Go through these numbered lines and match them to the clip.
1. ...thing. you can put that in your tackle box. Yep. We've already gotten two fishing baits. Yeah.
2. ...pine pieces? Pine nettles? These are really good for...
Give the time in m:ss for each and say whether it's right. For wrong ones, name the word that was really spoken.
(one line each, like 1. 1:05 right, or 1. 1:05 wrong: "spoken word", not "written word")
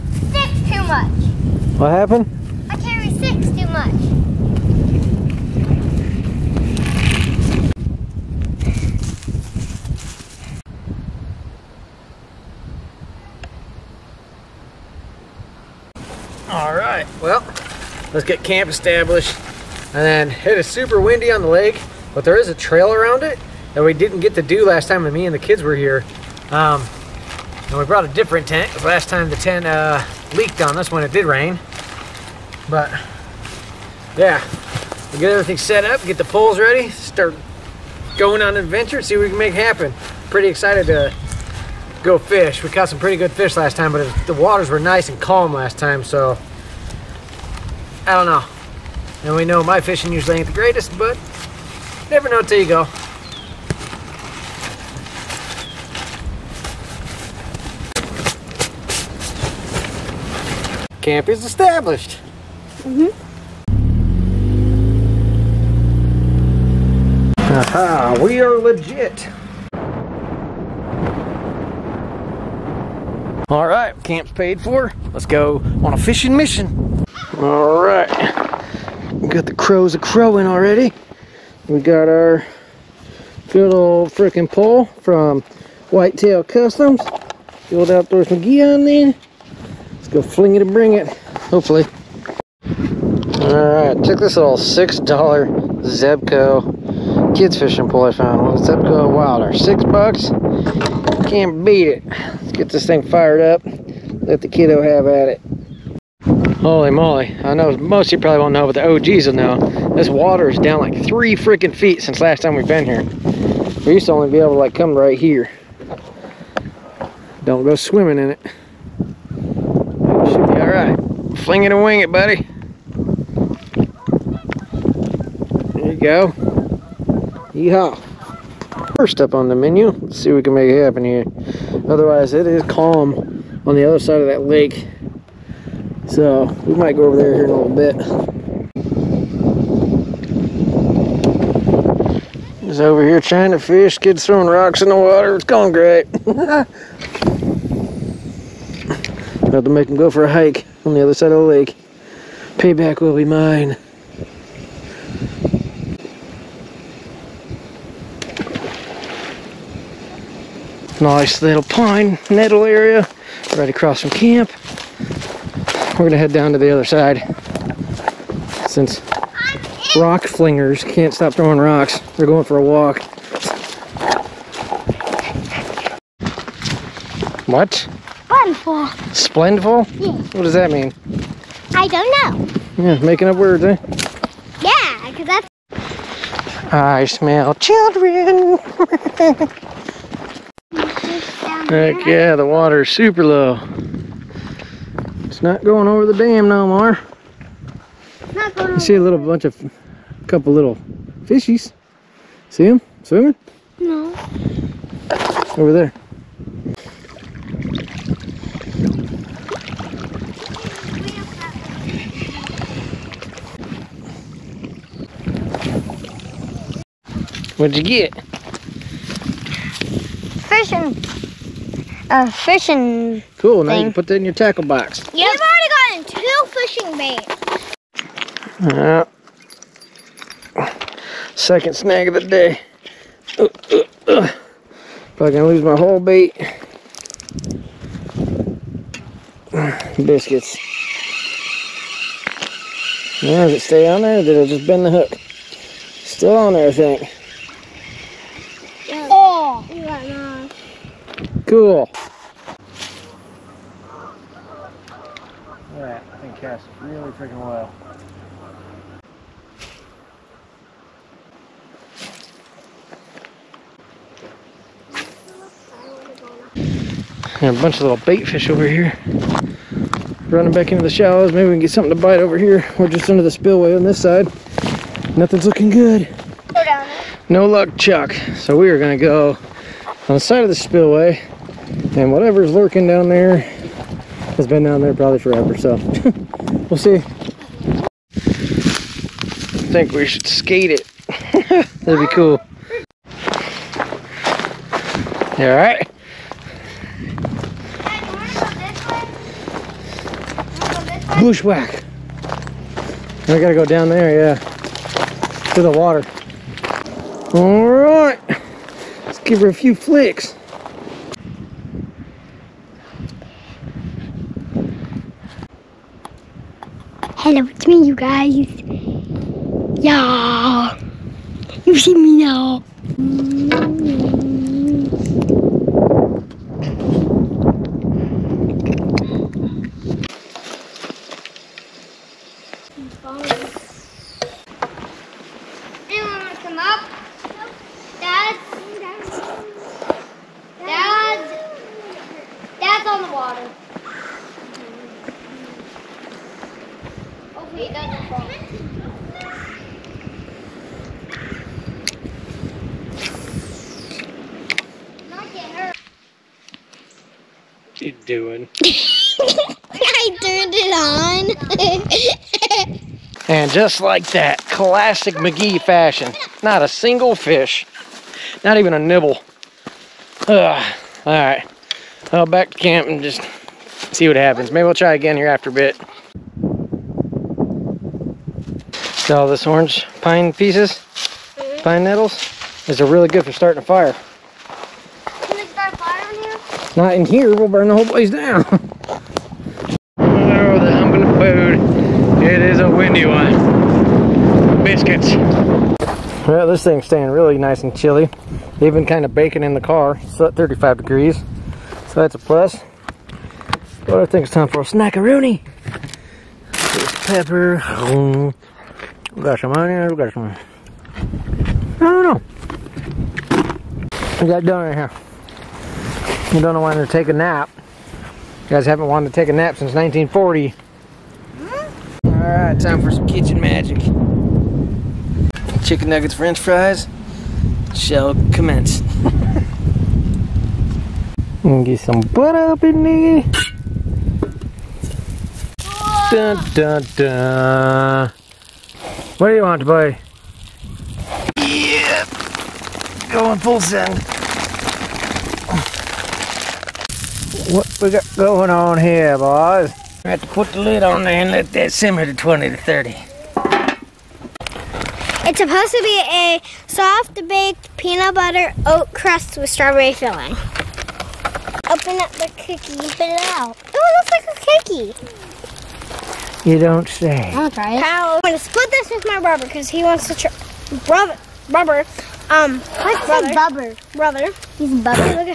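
1. 3:43 right
2. 6:19 right.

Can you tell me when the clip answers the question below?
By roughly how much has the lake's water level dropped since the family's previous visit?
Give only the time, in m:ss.
1:51.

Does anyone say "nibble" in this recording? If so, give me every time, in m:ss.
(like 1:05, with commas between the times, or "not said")
6:08.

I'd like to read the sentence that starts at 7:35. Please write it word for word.
It's supposed to be a soft baked peanut butter oat crust with strawberry filling.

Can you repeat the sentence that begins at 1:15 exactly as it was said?
Let's go on a fishing mission.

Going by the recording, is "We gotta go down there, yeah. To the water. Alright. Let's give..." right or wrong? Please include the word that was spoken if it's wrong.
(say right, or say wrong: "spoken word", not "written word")
right.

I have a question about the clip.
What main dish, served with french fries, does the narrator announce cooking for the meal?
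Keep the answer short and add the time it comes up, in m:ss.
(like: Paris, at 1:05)
Chicken nuggets, at 7:05.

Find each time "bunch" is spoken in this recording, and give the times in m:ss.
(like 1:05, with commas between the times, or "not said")
3:19, 4:27.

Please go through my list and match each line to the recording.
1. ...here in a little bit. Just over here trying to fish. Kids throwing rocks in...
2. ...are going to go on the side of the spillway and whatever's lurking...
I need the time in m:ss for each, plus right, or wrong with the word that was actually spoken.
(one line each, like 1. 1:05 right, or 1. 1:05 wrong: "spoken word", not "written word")
1. 2:17 right
2. 4:38 right.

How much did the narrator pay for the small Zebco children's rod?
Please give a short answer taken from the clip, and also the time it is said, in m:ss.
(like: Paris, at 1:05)
$6, at 1:34.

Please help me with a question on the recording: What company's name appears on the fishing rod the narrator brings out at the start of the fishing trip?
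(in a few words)
Whitetail Customs.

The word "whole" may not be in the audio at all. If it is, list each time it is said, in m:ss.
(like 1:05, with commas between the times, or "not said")
3:55, 6:27.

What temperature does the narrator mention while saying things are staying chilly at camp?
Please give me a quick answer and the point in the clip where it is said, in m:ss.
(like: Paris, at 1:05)
35 degrees, at 6:40.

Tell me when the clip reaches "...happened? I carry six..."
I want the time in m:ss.
0:01.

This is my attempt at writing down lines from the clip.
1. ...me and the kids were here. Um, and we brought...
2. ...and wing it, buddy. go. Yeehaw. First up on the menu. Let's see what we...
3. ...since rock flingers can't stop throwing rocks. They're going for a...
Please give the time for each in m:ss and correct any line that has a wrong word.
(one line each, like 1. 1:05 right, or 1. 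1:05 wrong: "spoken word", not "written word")
1. 0:25 right
2. 2:01 right
3. 2:48 right.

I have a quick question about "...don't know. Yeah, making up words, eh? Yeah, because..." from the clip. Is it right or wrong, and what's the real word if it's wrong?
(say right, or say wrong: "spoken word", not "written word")
right.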